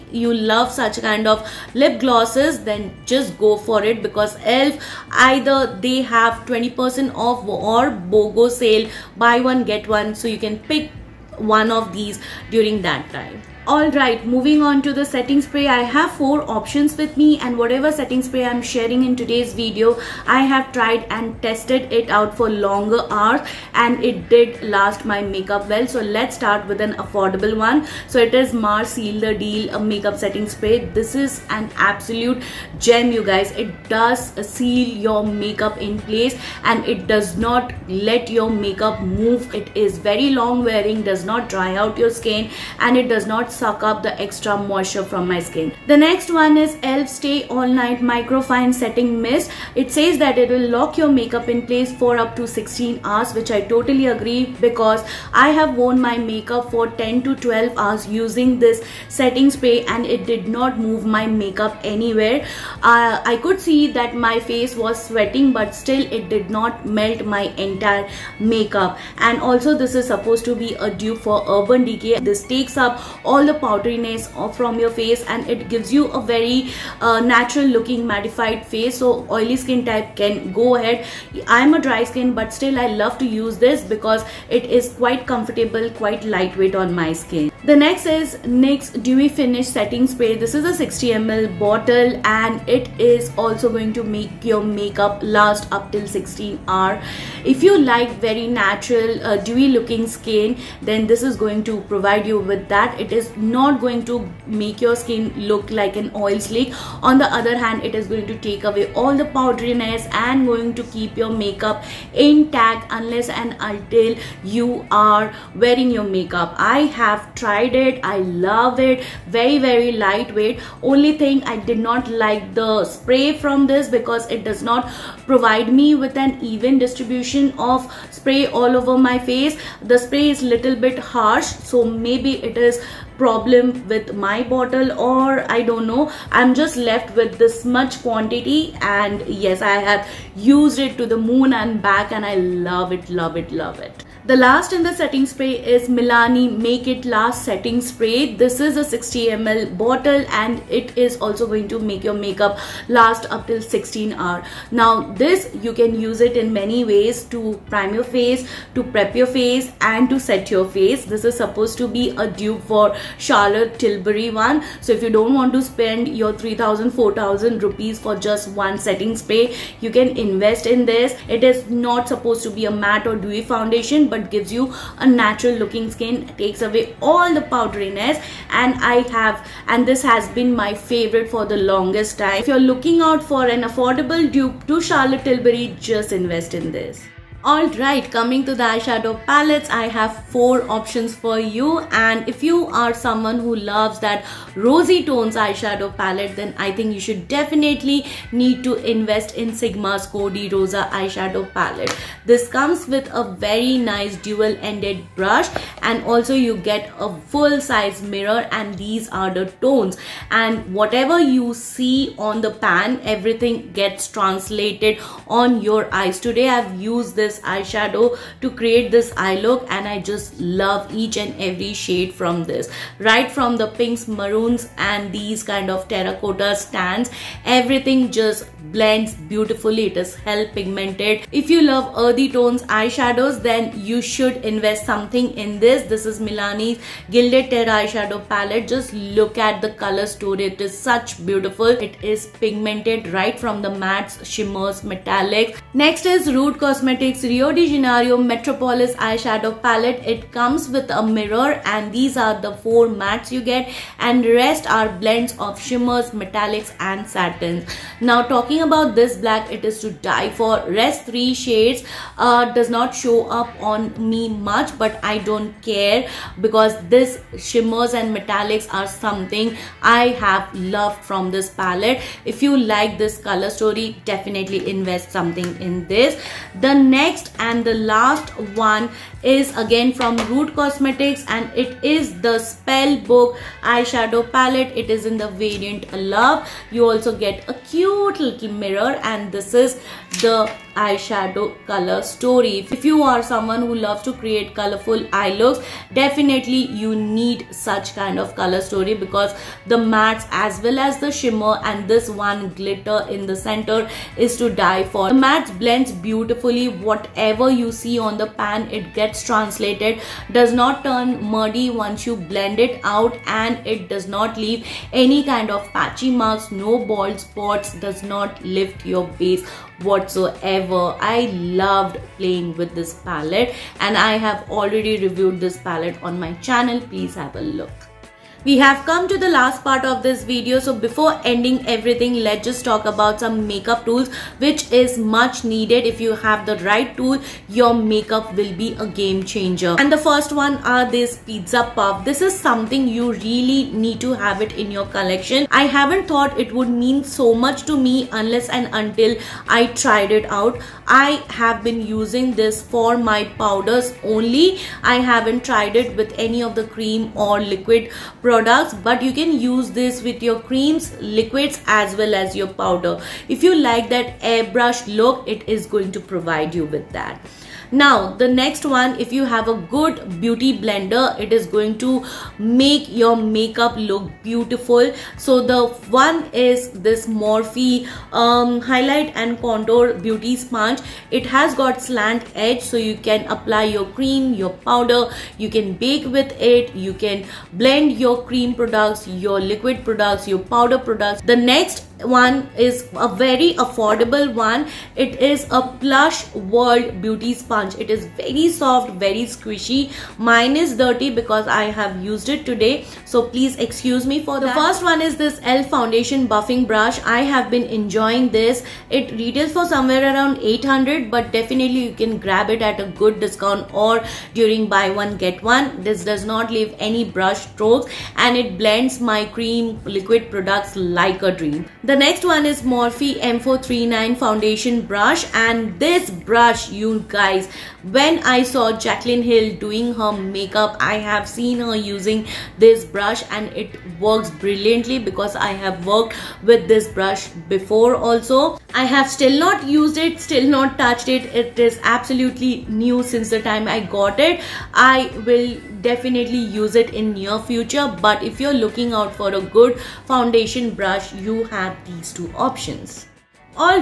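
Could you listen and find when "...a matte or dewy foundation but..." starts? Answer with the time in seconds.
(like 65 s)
172 s.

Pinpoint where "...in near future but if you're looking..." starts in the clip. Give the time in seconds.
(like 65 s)
446 s.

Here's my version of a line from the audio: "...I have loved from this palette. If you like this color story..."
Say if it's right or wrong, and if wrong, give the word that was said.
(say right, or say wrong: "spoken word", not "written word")
right.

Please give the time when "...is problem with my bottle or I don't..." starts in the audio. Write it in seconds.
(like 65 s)
132 s.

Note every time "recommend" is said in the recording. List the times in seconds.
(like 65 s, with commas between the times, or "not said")
not said.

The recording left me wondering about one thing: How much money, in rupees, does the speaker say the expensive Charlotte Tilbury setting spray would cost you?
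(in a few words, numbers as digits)
3000 4000 rupees.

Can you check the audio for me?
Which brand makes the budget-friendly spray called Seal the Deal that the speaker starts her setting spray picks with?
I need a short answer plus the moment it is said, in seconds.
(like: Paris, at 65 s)
Mars, at 28 s.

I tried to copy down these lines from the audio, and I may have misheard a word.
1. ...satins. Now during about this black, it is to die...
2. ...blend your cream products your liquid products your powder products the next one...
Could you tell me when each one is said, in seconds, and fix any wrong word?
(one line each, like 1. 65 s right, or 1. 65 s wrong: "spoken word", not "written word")
1. 257 s wrong: "talking", not "during"
2. 387 s right.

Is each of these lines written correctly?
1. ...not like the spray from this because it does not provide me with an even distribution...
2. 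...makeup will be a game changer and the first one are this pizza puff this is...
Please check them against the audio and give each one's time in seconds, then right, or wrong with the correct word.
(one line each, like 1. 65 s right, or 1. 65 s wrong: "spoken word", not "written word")
1. 121 s right
2. 337 s right.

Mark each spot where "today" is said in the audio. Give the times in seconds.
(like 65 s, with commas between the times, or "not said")
19 s, 216 s, 402 s.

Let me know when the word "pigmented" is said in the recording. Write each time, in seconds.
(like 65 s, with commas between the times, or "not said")
230 s, 242 s.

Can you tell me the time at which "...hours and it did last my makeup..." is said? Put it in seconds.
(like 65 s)
23 s.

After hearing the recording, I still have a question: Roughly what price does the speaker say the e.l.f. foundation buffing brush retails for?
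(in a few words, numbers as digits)
800.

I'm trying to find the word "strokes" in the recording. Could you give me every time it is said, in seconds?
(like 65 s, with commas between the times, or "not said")
417 s.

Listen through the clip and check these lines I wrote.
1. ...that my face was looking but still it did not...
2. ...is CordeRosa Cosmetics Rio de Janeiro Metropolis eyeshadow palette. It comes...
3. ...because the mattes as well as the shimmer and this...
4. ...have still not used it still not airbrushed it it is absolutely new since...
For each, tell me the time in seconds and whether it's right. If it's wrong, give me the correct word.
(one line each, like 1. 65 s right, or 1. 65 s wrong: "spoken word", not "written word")
1. 63 s wrong: "sweating", not "looking"
2. 246 s wrong: "Rude", not "CordeRosa"
3. 298 s right
4. 438 s wrong: "touched", not "airbrushed".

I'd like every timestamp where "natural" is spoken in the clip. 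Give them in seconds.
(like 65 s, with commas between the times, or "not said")
77 s, 98 s, 175 s.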